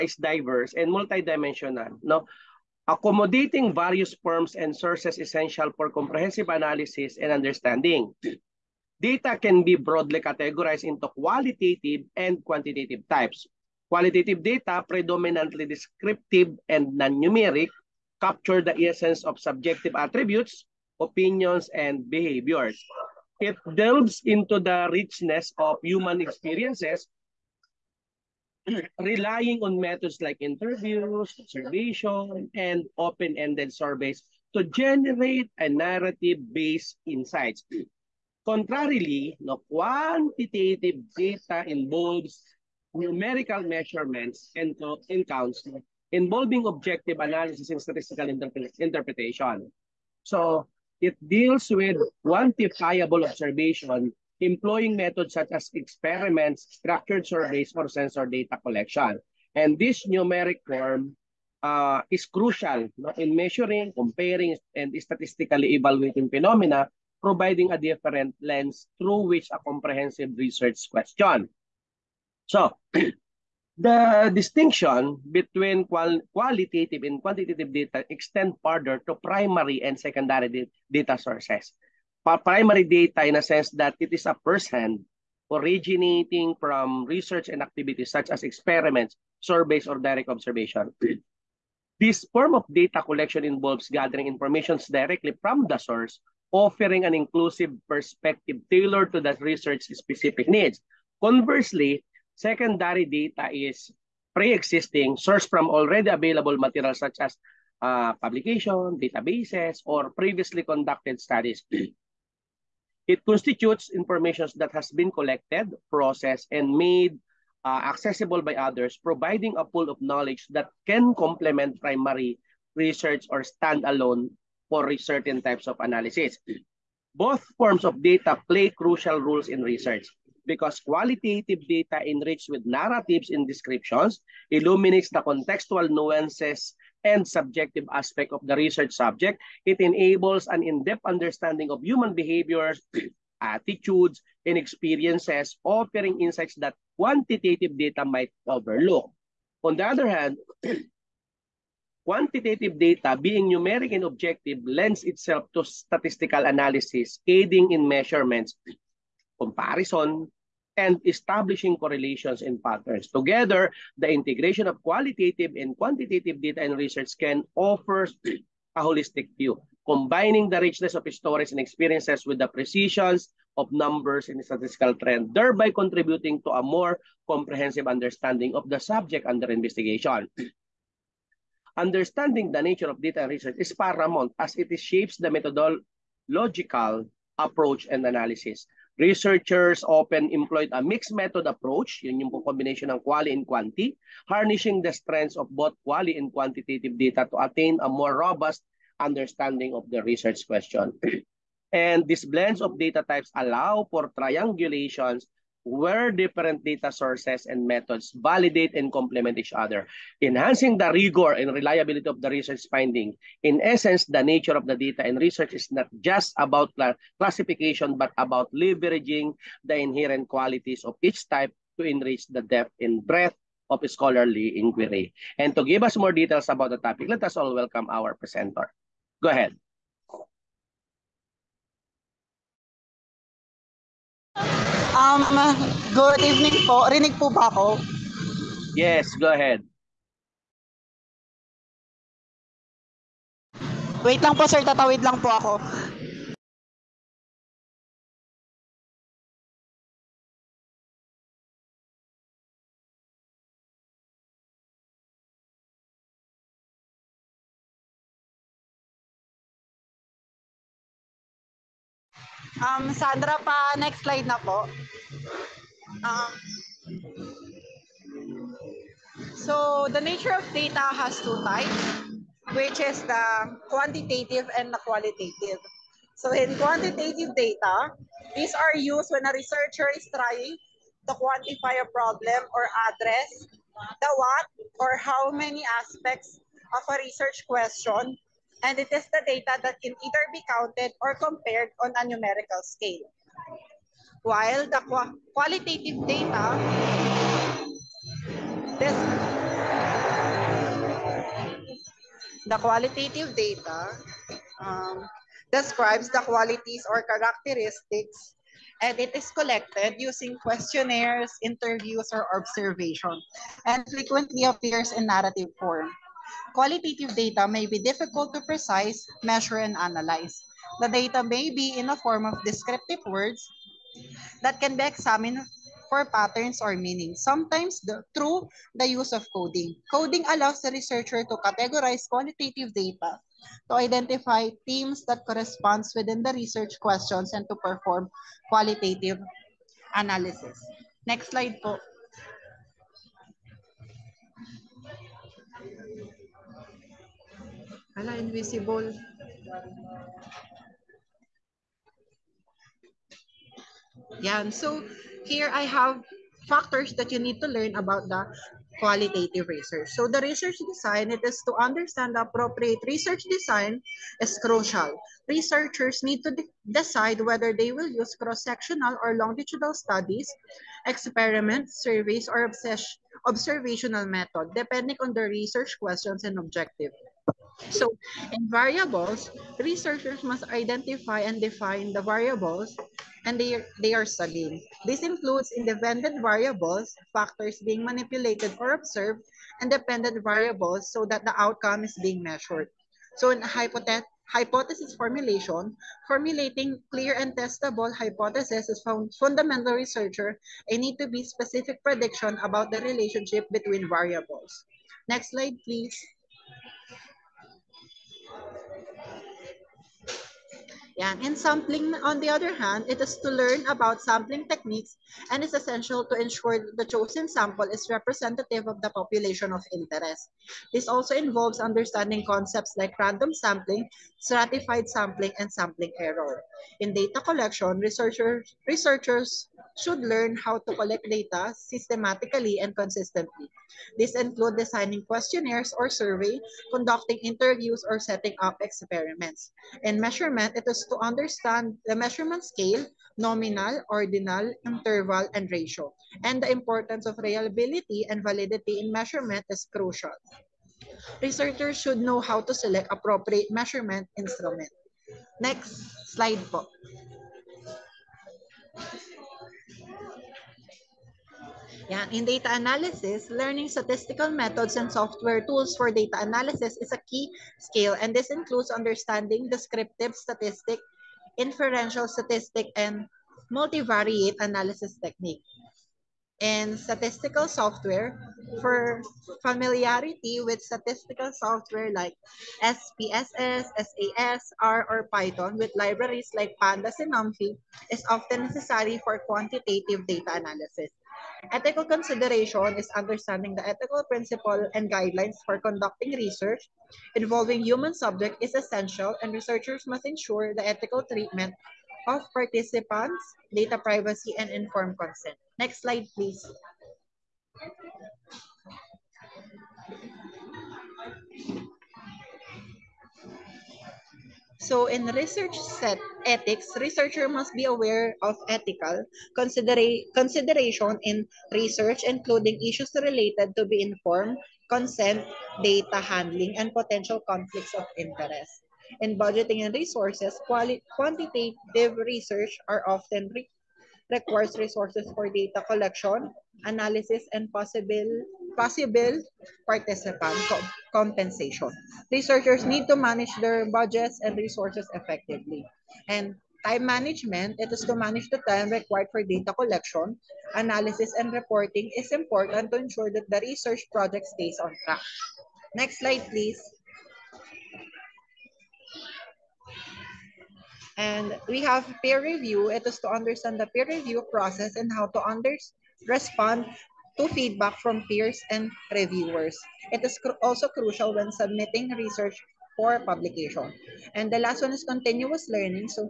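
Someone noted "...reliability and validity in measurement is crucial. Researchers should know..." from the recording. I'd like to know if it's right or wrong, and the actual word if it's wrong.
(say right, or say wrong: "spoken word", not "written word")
right.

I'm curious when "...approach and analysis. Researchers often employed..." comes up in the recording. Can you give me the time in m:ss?
3:07.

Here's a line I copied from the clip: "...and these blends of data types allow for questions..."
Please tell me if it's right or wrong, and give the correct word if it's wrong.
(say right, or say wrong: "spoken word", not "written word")
wrong: "triangulations", not "questions".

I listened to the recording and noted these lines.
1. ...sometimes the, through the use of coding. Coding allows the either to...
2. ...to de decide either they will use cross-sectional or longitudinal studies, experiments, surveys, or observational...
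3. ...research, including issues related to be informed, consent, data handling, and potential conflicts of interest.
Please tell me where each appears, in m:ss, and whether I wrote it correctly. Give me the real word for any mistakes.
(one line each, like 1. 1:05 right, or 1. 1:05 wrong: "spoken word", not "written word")
1. 5:27 wrong: "researcher", not "either"
2. 6:06 wrong: "whether", not "either"
3. 8:41 right.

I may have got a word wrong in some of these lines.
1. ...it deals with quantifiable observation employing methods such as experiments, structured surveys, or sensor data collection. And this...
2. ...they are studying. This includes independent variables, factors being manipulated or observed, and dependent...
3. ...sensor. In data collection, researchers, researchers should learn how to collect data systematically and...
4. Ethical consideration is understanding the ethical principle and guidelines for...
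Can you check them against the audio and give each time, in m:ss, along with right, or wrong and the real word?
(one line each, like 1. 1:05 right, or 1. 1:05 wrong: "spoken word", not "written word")
1. 0:51 right
2. 6:23 right
3. 7:05 wrong: "error", not "sensor"
4. 8:11 right.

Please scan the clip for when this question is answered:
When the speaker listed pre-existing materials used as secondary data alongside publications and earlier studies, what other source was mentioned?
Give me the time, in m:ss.
1:48.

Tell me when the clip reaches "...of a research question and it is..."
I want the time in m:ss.
4:46.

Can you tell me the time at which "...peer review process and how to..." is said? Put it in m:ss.
9:23.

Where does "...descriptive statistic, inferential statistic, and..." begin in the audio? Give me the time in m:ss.
7:49.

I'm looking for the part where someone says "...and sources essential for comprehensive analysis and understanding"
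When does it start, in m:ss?
0:04.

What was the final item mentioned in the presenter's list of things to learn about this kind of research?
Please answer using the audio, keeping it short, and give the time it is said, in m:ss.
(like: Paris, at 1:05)
continuous learning, at 9:34.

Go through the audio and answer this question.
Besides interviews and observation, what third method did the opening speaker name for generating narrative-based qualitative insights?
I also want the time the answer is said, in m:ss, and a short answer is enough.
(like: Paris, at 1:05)
open-ended surveys, at 0:32.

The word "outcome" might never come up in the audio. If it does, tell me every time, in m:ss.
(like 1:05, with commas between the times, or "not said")
6:31.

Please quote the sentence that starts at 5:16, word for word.
Qualitative data may be difficult to precise, measure, and analyze.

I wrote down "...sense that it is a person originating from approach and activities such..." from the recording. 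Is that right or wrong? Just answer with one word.
wrong.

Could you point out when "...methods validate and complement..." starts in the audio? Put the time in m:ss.
3:27.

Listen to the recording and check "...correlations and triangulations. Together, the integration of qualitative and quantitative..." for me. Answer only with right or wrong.
wrong.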